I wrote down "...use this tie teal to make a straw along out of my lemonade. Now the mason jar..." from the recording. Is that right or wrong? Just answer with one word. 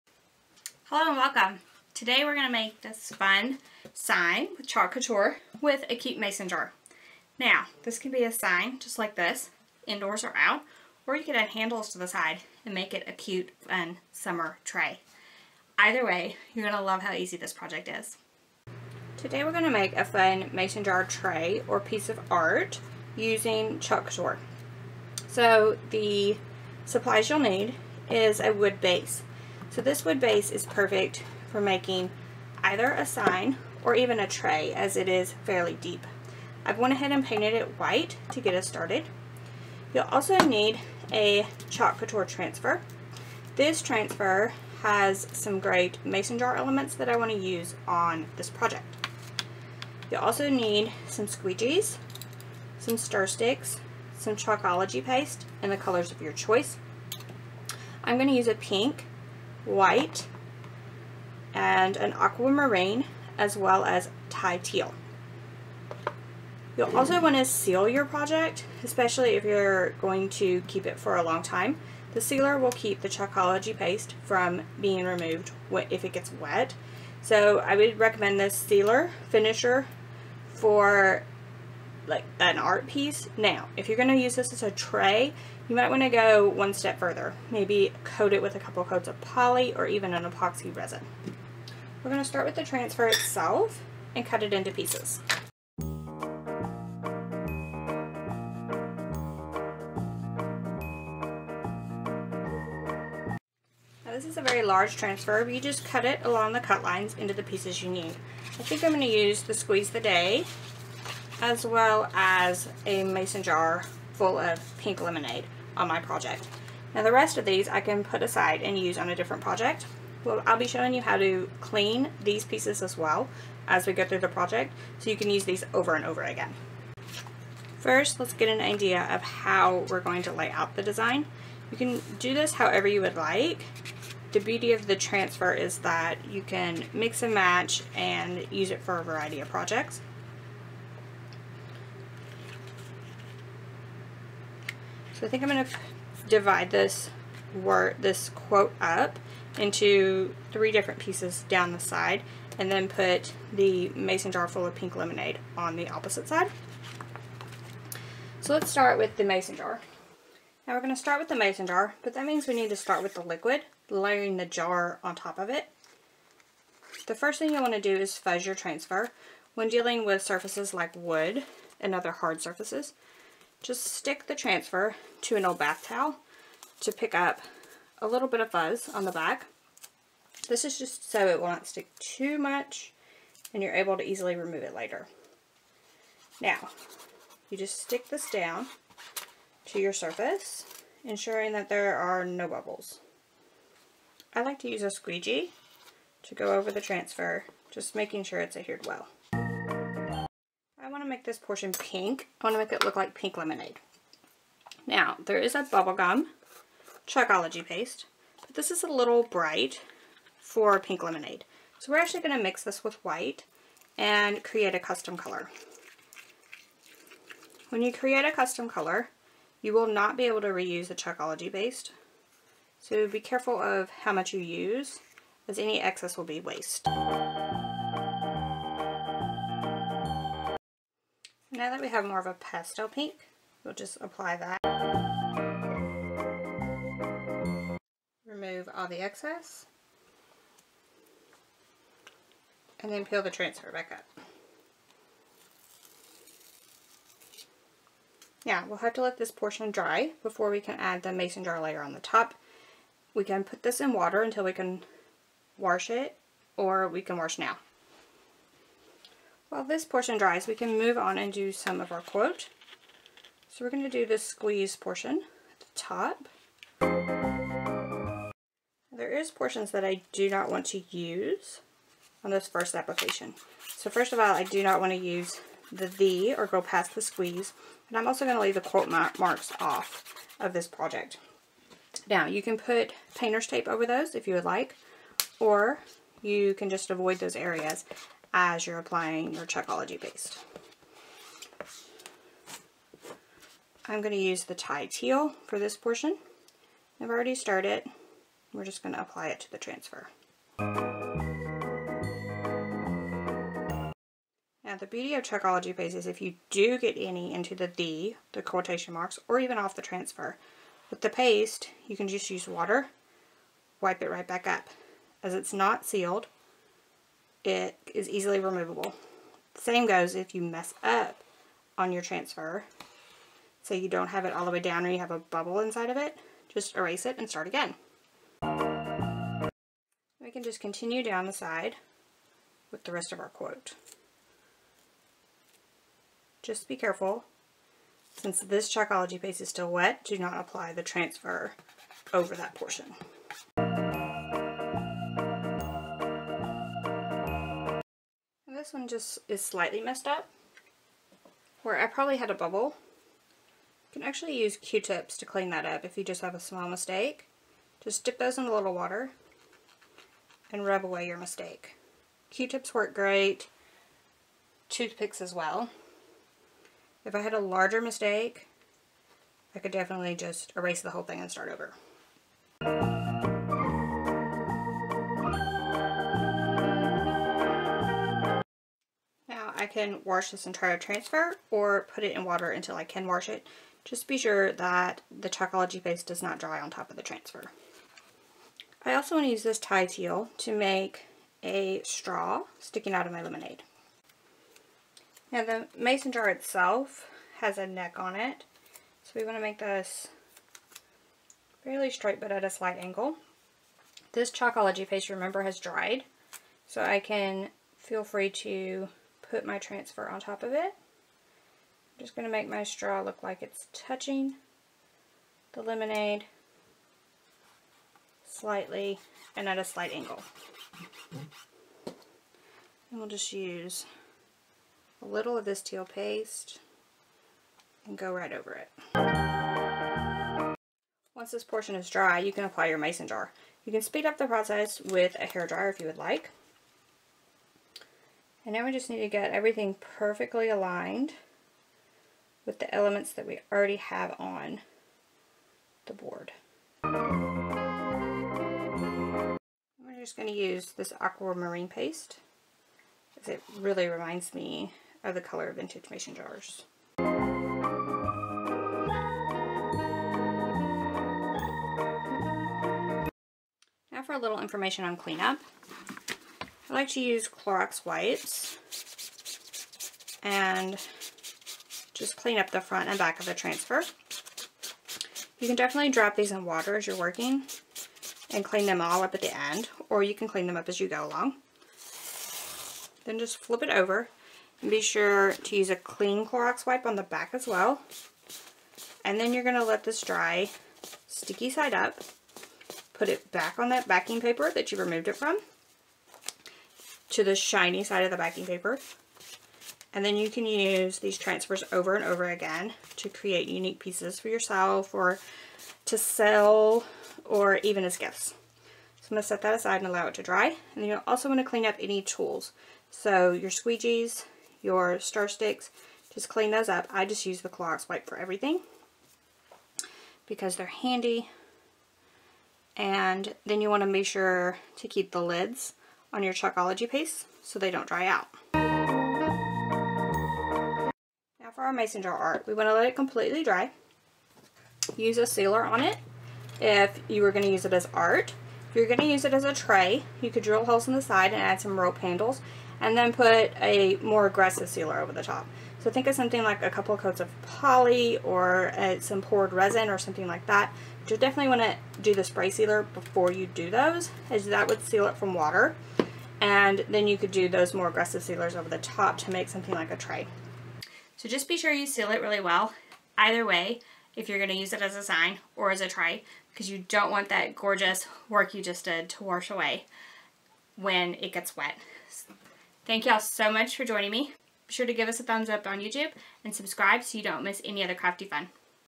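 wrong.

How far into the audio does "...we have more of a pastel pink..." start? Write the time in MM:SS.
03:51.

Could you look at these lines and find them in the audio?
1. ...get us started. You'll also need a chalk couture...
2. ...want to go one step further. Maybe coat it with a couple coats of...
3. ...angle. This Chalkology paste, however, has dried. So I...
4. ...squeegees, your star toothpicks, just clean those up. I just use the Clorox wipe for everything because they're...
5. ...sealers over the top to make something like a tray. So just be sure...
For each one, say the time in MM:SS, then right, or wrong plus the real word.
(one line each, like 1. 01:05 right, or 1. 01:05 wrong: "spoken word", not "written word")
1. 00:38 right
2. 01:25 right
3. 06:42 wrong: "remember", not "however"
4. 08:33 wrong: "sticks", not "toothpicks"
5. 09:18 right.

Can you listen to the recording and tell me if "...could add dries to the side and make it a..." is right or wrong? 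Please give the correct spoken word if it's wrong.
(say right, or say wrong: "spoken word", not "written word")
wrong: "handles", not "dries".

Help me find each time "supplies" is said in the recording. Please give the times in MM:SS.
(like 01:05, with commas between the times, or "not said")
00:26.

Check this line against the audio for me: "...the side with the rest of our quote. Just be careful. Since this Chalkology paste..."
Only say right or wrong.
right.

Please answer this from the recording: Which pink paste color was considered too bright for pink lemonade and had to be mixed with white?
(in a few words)
Bubblegum.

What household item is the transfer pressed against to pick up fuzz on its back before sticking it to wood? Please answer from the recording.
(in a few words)
An old bath towel.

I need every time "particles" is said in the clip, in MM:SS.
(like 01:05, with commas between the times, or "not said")
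not said.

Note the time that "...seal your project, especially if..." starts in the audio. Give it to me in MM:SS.
01:07.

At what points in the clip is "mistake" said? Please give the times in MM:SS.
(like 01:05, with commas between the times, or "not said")
05:56, 06:01, 06:07.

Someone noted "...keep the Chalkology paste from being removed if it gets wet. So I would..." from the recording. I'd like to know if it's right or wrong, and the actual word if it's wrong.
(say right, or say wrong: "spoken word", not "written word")
right.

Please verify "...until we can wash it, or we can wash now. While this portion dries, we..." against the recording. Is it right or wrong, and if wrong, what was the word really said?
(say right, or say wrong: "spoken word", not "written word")
right.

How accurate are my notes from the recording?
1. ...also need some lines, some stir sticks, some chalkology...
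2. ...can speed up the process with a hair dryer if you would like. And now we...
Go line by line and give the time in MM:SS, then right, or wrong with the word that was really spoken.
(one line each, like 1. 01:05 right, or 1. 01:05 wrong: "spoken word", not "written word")
1. 00:50 wrong: "squeegees", not "lines"
2. 07:13 right.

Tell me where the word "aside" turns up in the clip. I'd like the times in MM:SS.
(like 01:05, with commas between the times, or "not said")
01:58, 08:29.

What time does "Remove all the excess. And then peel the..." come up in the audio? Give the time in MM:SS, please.
03:58.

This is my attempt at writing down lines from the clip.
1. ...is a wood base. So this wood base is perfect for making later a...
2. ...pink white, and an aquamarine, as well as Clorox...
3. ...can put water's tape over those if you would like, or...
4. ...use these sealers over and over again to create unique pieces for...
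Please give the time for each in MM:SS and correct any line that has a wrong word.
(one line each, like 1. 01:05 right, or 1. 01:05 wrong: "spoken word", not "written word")
1. 00:28 wrong: "either", not "later"
2. 00:58 wrong: "Thai", not "Clorox"
3. 04:42 wrong: "painter", not "water"
4. 08:20 wrong: "transfers", not "sealers".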